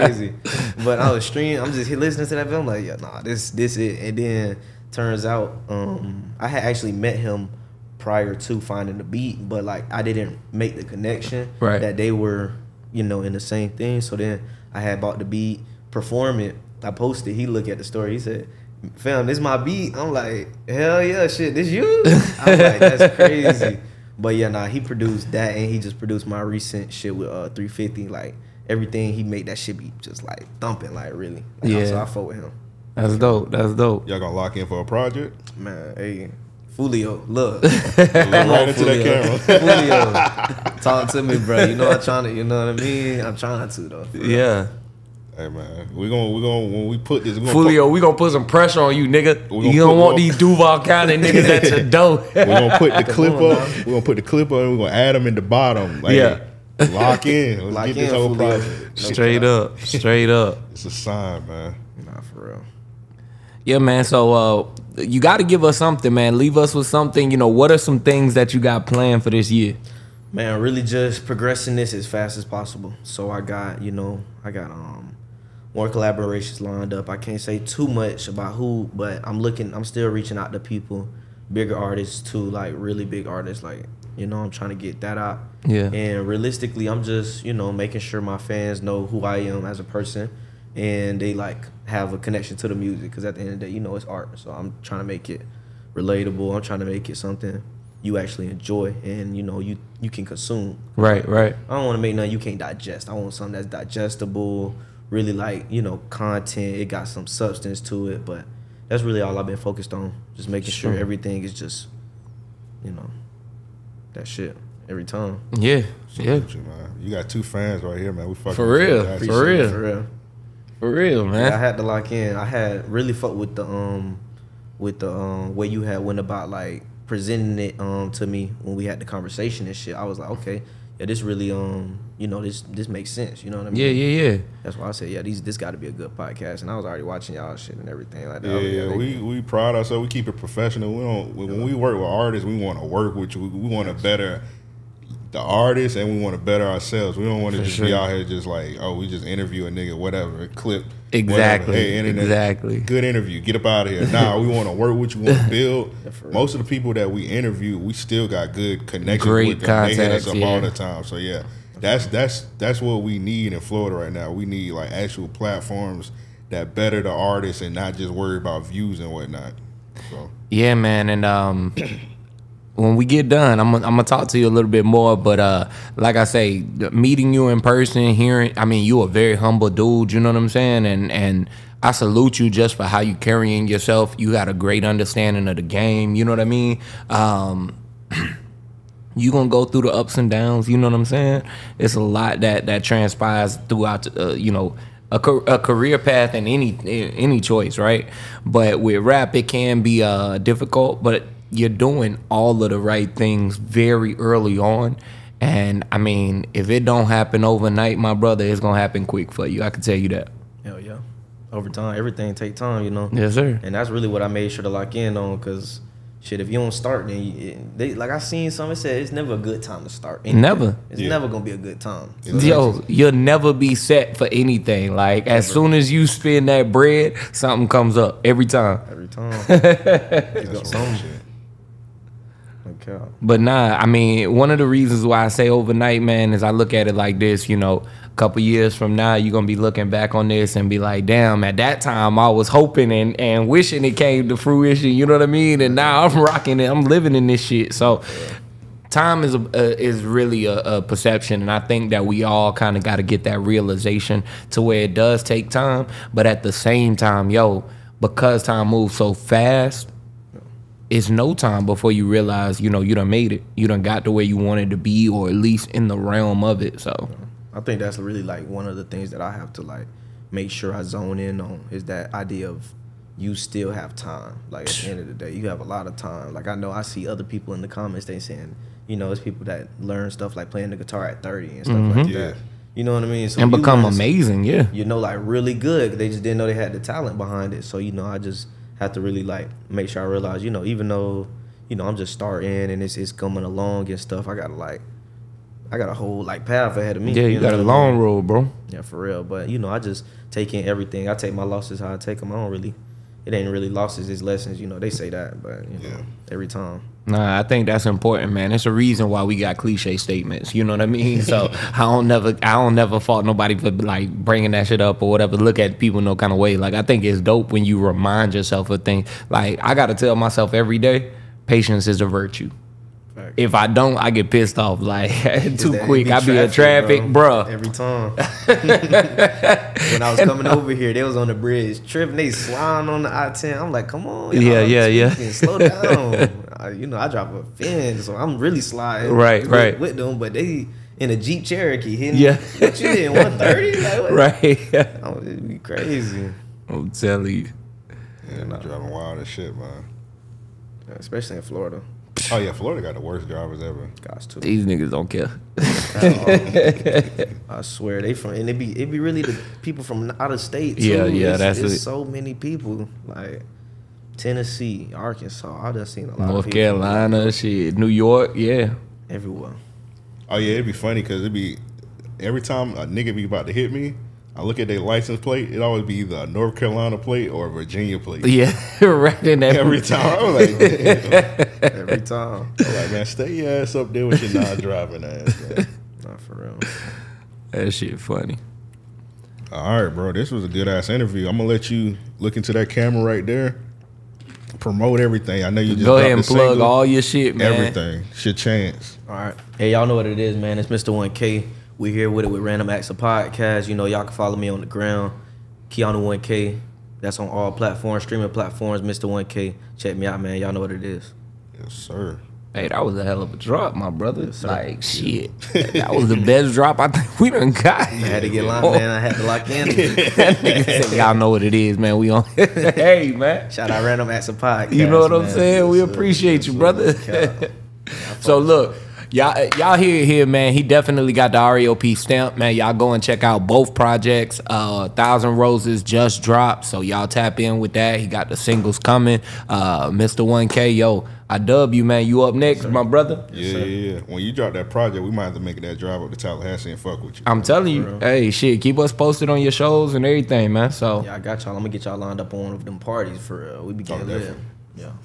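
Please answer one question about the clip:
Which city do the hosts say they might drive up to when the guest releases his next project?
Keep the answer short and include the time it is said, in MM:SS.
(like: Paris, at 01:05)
Tallahassee, at 07:26.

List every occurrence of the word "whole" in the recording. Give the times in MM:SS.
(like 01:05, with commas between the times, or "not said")
00:58, 04:55.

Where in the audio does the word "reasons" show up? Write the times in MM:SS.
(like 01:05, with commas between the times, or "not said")
03:54, 05:08.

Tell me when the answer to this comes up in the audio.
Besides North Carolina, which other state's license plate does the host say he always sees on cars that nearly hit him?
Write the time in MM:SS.
06:17.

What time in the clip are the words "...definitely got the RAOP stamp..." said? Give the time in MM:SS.
07:10.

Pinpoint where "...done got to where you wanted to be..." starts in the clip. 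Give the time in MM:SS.
04:23.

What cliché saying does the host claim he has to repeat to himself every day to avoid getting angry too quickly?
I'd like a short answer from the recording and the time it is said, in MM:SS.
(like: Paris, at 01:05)
Patience is a virtue, at 05:21.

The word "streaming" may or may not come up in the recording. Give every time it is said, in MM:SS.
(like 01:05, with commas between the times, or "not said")
00:01, 06:48.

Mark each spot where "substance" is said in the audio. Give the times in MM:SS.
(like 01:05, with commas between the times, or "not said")
01:47.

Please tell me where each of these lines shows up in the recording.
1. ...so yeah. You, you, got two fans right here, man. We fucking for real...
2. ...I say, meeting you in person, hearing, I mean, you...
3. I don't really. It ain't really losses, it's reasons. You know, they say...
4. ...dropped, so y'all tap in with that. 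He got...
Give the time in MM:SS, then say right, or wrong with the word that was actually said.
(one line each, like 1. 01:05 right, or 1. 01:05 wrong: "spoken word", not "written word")
1. 01:56 right
2. 02:56 right
3. 05:02 wrong: "lessons", not "reasons"
4. 07:16 right.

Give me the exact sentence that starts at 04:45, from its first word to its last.
They just didn't know they had the talent behind it.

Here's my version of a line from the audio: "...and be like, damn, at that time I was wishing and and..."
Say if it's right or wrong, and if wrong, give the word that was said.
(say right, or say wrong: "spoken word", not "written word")
wrong: "hoping", not "wishing".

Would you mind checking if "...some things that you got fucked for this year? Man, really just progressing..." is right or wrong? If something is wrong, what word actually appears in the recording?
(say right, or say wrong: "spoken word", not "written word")
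wrong: "planned", not "fucked".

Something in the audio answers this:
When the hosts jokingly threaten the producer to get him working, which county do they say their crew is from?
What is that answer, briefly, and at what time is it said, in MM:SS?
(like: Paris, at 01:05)
Duval County, at 00:50.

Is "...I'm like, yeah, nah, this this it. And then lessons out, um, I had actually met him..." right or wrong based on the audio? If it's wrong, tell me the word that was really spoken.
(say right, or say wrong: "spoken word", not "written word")
wrong: "turns", not "lessons".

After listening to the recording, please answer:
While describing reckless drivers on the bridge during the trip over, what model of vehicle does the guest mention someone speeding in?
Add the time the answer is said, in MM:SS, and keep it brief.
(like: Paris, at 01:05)
Jeep Cherokee, at 05:41.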